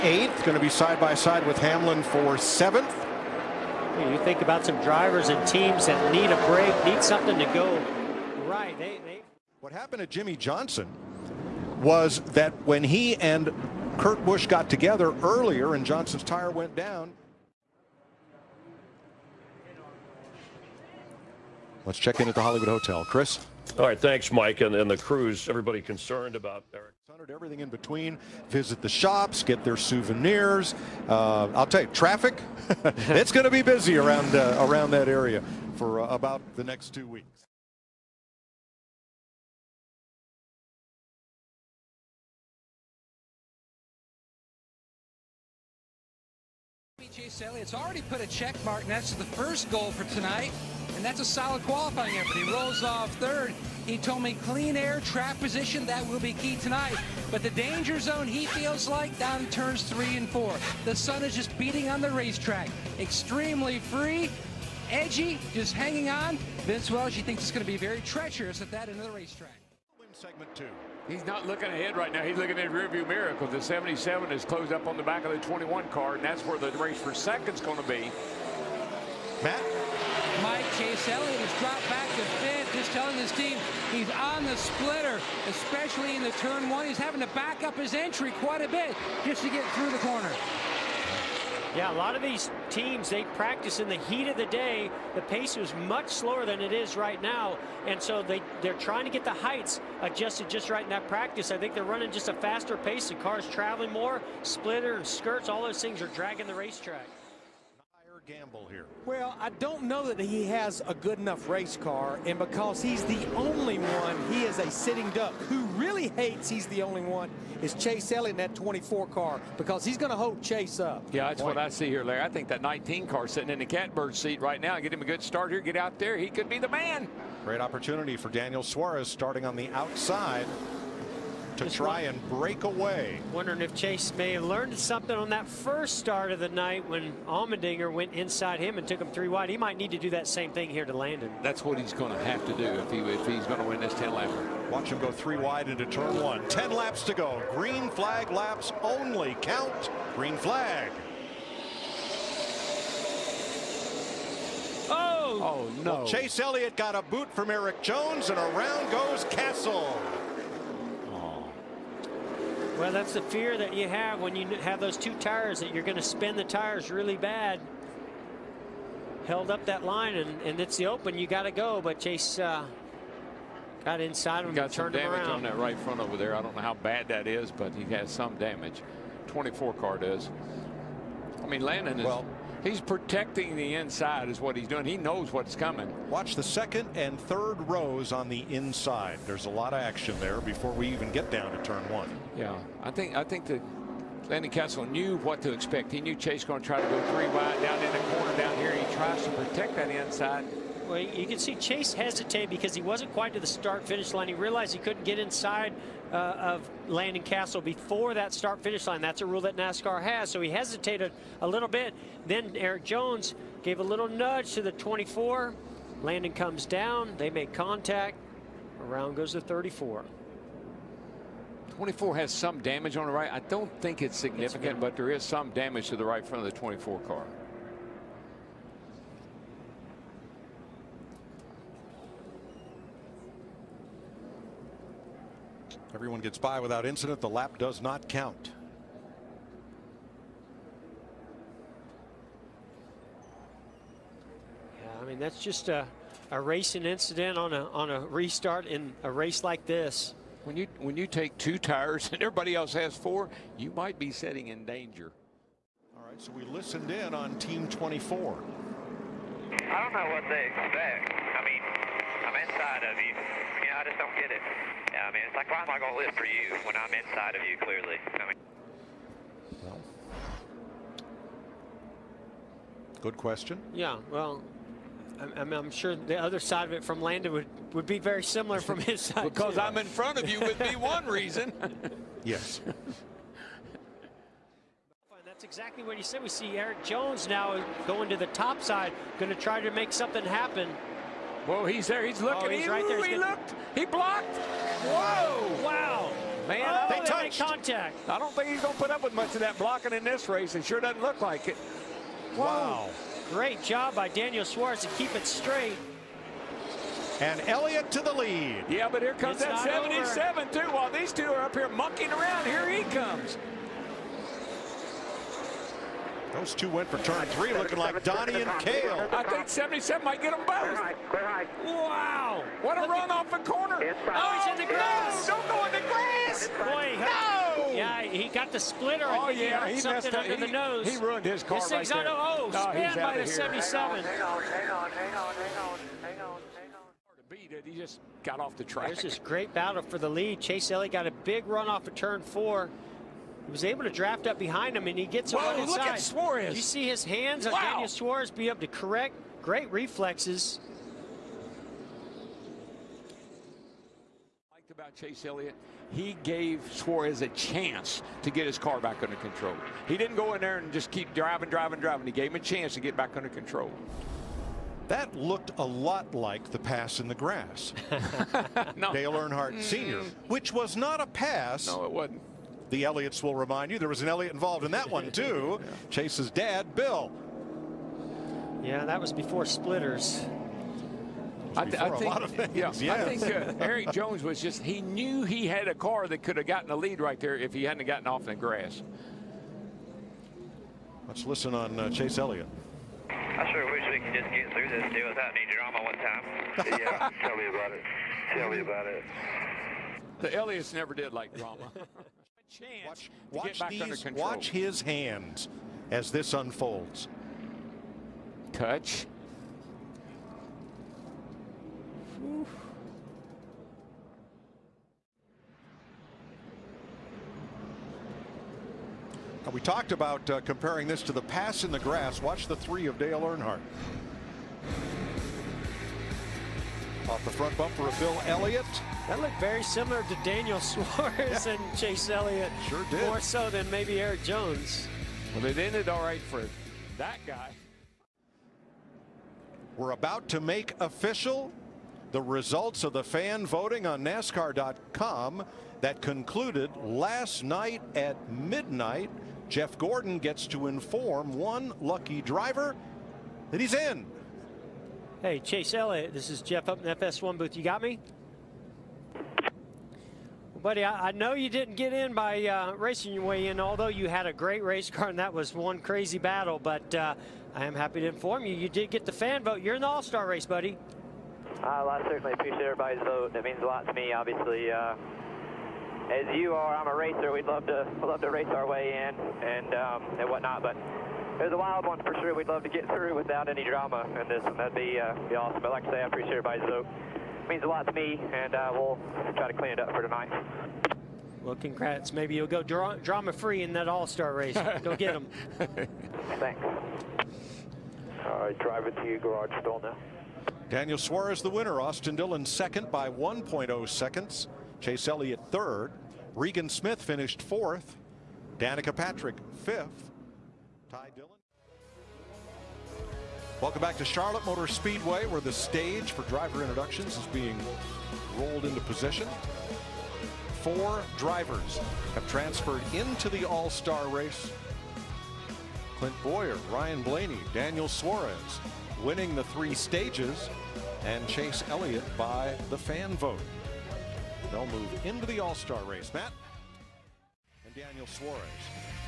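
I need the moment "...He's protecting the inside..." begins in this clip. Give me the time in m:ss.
3:02.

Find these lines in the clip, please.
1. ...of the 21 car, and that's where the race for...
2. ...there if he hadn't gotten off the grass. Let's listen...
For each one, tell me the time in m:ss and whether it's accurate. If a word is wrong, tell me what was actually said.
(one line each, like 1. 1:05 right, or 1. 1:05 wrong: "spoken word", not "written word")
1. 1:15 right
2. 6:27 right.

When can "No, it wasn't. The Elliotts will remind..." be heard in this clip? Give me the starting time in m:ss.
6:11.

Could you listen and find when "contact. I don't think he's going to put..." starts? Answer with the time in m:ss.
4:57.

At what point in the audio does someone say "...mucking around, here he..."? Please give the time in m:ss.
5:11.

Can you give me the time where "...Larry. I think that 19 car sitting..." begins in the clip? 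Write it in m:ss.
2:02.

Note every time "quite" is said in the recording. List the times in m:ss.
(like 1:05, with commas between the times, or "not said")
1:28, 3:23.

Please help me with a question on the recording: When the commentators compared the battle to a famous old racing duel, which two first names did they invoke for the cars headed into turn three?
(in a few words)
Donnie and Cale.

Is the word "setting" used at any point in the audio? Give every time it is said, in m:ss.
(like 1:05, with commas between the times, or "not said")
4:14.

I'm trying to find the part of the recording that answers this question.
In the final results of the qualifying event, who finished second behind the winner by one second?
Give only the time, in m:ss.
8:21.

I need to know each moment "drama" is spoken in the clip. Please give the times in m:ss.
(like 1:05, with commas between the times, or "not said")
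6:35, 6:41, 8:03, 8:13.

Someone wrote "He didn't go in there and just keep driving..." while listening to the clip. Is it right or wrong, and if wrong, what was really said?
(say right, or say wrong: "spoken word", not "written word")
right.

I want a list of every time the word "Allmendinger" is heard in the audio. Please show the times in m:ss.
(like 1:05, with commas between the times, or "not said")
2:17.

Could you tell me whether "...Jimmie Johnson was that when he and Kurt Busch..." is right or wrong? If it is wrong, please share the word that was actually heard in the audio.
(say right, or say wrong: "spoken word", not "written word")
right.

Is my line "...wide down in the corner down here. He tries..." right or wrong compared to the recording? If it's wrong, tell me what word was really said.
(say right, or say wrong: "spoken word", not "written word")
right.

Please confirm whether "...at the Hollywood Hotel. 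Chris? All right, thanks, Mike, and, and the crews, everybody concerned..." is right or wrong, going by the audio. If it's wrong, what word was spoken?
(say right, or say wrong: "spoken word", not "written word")
right.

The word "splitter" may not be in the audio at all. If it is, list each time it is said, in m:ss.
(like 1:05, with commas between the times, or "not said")
1:24, 1:44, 5:28, 6:19.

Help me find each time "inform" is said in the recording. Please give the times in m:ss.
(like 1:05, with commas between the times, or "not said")
7:30, 7:48.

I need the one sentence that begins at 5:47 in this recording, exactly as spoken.
on Daniel Suarez be able to correct.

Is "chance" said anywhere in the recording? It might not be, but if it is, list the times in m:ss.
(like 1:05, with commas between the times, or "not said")
5:57, 6:02.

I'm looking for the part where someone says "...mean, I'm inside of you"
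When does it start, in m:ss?
4:21.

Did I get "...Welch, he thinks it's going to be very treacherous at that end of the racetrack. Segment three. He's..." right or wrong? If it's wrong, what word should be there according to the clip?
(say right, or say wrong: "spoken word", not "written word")
wrong: "two", not "three".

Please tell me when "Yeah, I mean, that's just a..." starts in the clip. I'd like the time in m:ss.
4:04.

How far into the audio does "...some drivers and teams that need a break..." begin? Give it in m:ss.
0:04.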